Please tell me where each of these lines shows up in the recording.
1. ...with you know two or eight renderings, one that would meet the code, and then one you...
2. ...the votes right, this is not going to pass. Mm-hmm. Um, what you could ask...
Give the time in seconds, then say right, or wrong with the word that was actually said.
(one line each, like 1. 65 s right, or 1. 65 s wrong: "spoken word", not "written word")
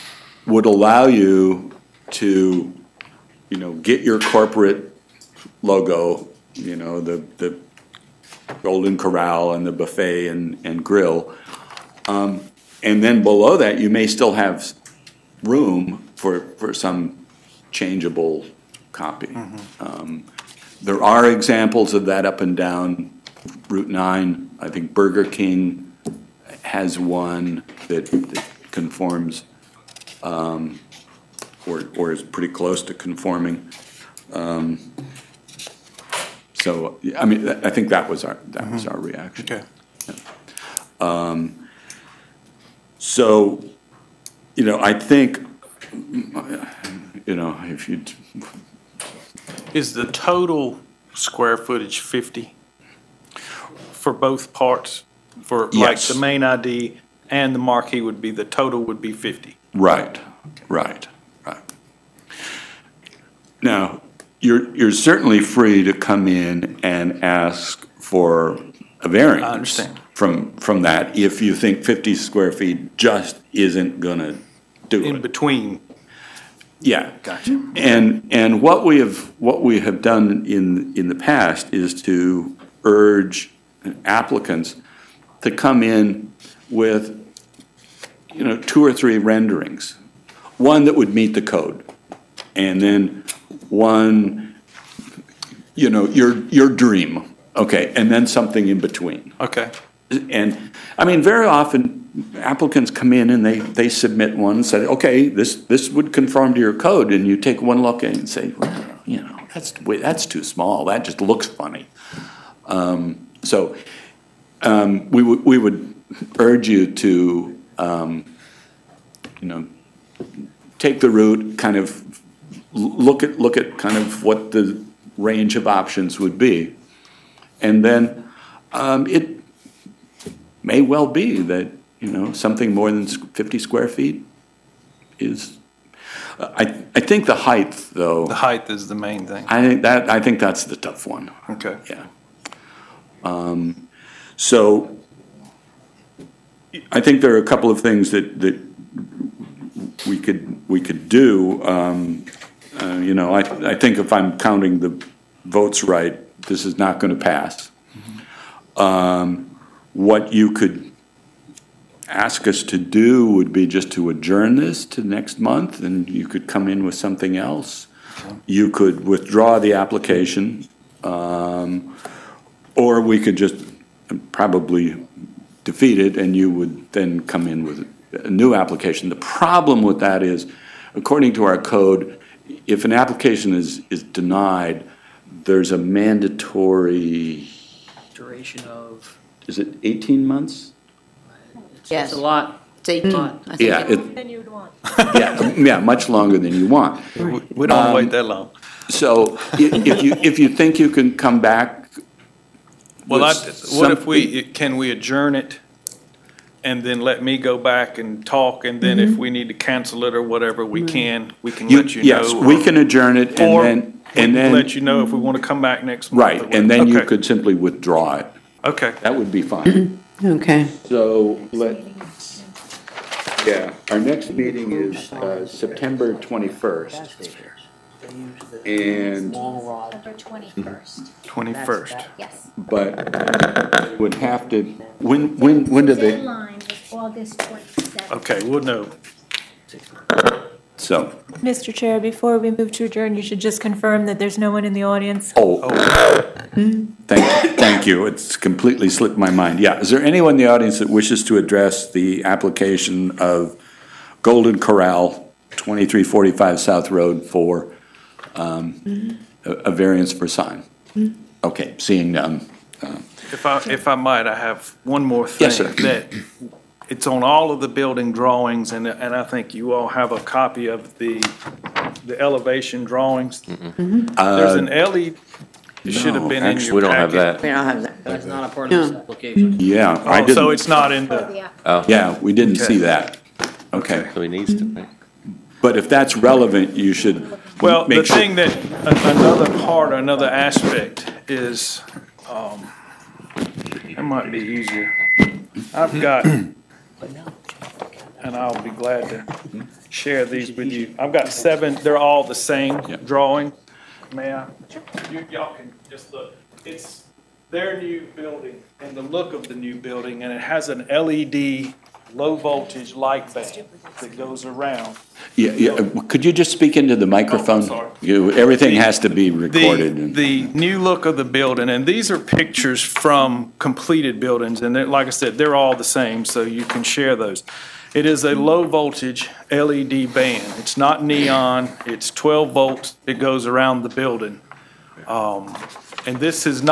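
1. 86 s wrong: "three", not "eight"
2. 154 s right.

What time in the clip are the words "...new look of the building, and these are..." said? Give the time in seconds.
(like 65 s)
320 s.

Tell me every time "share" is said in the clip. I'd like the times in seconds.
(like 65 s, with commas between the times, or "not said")
299 s, 326 s.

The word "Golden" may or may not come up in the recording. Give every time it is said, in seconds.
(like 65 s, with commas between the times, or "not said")
8 s, 254 s.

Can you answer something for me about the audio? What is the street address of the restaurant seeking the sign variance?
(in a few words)
2345 South Road.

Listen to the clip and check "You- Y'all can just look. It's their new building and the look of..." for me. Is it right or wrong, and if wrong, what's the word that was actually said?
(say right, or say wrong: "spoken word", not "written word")
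right.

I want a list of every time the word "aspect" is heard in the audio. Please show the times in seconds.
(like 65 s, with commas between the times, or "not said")
290 s.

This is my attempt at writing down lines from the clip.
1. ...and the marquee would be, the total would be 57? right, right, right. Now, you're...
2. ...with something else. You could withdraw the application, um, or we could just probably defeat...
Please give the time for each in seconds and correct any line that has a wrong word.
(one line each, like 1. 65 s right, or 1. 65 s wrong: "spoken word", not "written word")
1. 57 s wrong: "50", not "57"
2. 166 s right.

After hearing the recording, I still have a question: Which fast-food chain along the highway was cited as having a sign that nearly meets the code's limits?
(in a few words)
Burger King.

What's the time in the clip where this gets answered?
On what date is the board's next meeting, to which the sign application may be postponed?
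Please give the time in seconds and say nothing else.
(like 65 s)
225 s.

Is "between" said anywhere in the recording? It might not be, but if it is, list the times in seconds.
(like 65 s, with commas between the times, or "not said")
75 s, 98 s.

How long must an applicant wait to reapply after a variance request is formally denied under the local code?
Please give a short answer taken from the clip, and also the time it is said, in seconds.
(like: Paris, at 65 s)
18 months, at 189 s.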